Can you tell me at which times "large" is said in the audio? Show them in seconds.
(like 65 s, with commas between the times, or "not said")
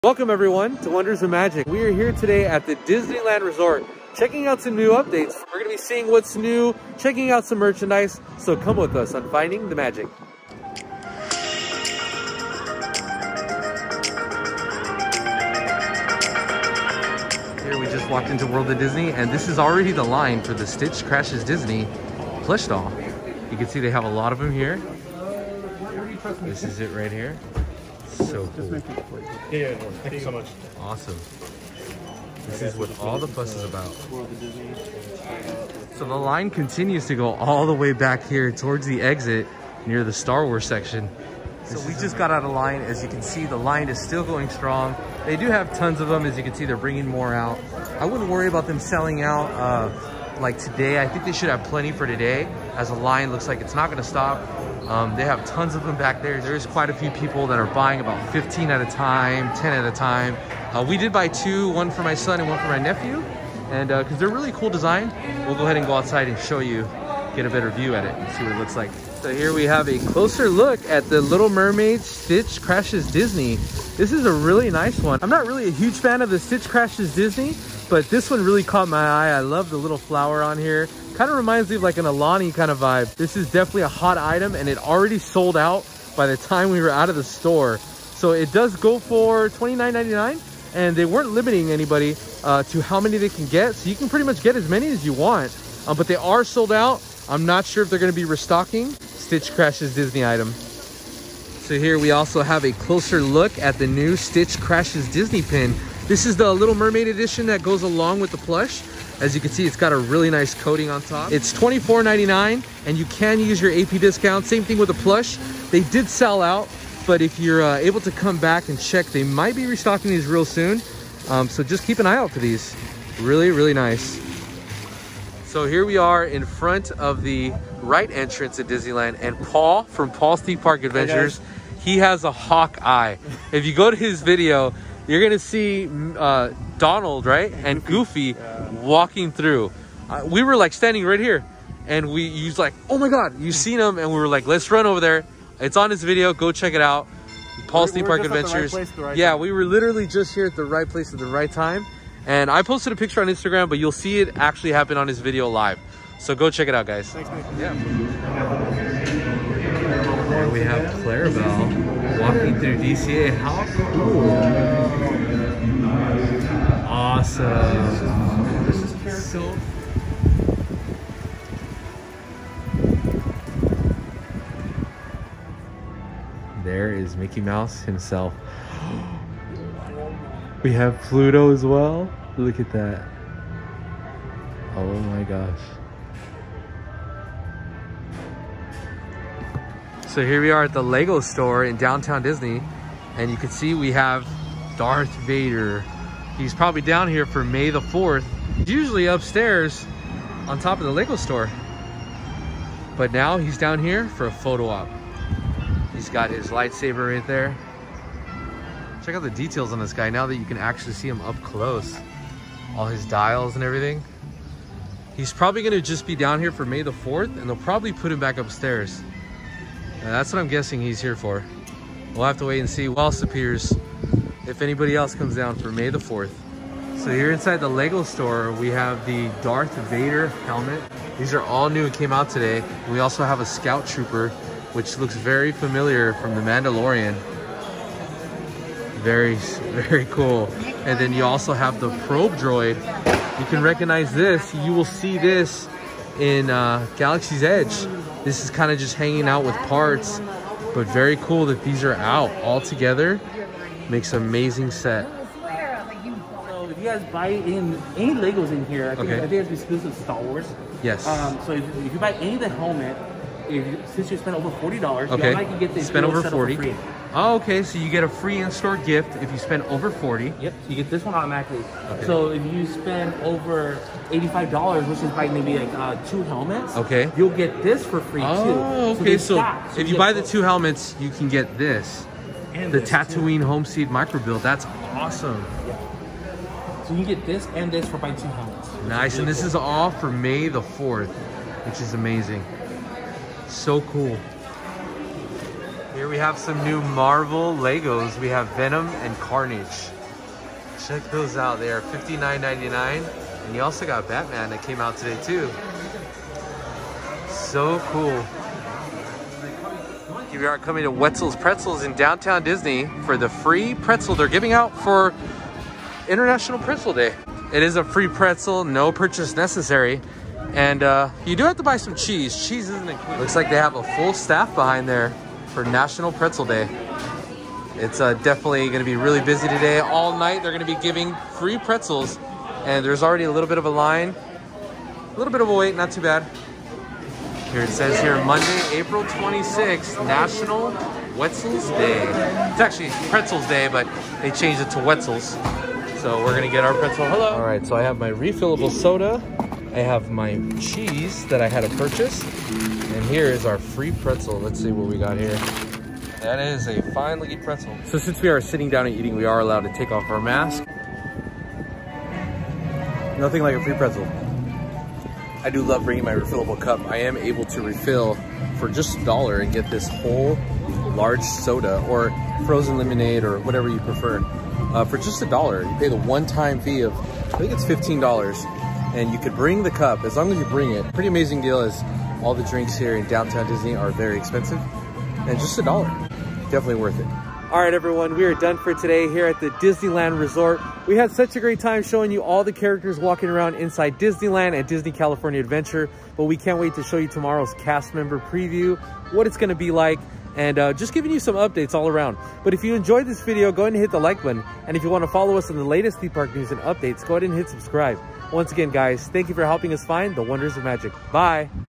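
370 s.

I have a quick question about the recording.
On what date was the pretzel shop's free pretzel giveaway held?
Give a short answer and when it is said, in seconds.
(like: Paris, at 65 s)
Monday, April 26th, at 338 s.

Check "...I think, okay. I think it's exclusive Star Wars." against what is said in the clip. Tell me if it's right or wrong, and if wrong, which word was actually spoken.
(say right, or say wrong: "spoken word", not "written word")
right.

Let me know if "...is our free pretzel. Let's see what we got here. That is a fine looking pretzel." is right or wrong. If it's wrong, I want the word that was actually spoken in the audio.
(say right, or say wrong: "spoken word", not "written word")
right.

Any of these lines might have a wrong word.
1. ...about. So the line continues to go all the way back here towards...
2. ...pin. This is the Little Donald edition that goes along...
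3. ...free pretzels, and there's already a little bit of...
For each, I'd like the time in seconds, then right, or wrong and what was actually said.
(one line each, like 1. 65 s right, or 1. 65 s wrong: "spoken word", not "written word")
1. 33 s right
2. 105 s wrong: "Mermaid", not "Donald"
3. 331 s right.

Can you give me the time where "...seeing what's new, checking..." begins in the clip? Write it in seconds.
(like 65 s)
5 s.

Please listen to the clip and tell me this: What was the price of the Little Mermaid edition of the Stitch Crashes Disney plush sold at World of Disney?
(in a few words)
$29.99.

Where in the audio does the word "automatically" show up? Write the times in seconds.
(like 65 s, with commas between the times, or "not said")
271 s.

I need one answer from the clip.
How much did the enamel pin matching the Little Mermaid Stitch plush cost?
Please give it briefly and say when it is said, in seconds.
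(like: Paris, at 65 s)
$24.99, at 111 s.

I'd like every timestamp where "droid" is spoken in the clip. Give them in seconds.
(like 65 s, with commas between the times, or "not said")
242 s.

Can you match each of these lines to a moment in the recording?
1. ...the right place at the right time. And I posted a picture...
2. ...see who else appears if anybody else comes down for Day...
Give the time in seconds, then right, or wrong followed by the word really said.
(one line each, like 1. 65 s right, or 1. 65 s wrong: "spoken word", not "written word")
1. 150 s right
2. 222 s wrong: "May", not "Day".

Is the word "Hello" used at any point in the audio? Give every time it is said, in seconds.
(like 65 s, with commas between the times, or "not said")
347 s.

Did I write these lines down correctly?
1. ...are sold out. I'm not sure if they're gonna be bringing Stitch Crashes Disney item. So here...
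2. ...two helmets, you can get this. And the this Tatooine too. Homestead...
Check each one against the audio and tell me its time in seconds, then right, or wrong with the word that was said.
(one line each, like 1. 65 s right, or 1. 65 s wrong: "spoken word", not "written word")
1. 96 s wrong: "restocking", not "bringing"
2. 280 s right.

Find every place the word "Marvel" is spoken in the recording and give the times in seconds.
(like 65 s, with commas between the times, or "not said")
296 s.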